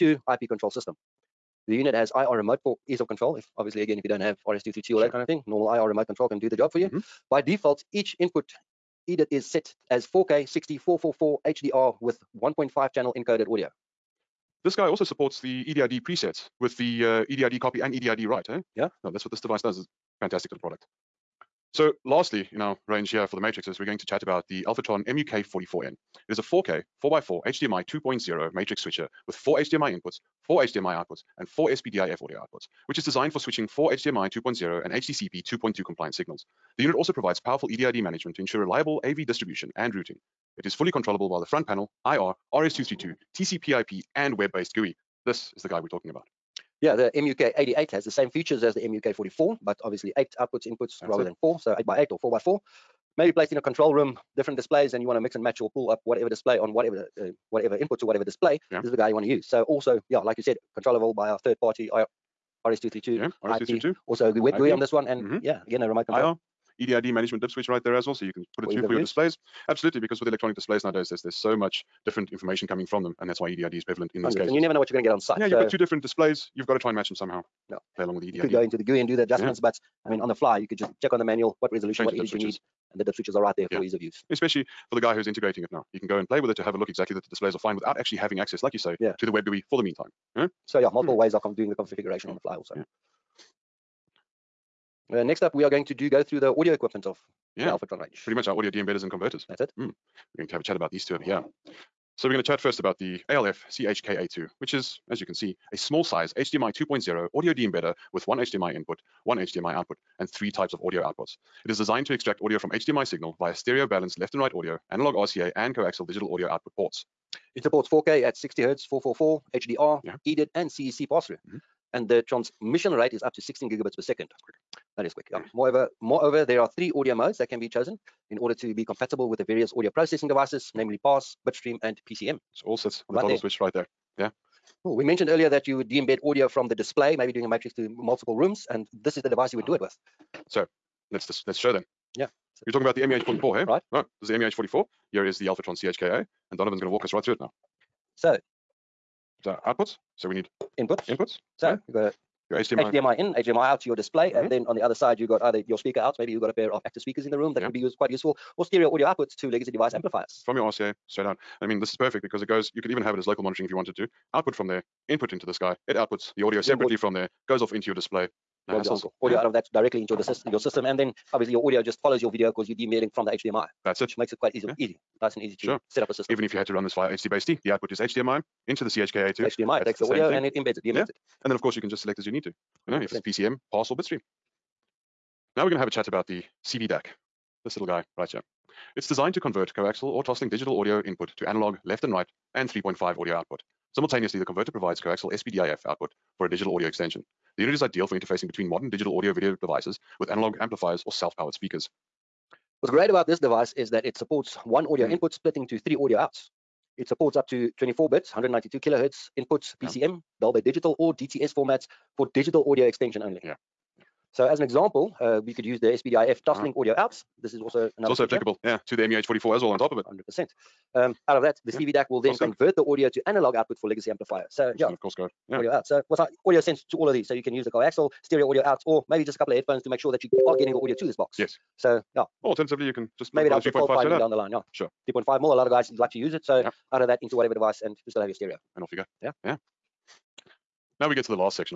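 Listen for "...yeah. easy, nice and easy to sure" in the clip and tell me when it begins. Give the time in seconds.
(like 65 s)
174 s.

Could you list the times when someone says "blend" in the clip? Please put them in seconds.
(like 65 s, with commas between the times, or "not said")
not said.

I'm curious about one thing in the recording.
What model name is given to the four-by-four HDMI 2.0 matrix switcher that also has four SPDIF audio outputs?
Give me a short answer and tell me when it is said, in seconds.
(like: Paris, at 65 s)
Alfatron MUK44N, at 24 s.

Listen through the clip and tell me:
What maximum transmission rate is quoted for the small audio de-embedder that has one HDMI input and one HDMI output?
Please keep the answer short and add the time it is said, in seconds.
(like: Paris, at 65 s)
16 gigabits per second, at 123 s.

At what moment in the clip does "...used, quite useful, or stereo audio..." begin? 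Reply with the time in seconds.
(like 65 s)
157 s.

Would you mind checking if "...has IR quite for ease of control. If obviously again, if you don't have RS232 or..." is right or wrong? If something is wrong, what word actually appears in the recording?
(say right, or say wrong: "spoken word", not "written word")
wrong: "remote", not "quite".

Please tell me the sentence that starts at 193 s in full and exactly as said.
Simultaneously, the converter provides coaxial SPDIF output for a digital audio extension.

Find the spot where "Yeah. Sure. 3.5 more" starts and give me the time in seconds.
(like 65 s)
234 s.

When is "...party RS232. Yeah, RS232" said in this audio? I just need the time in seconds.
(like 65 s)
61 s.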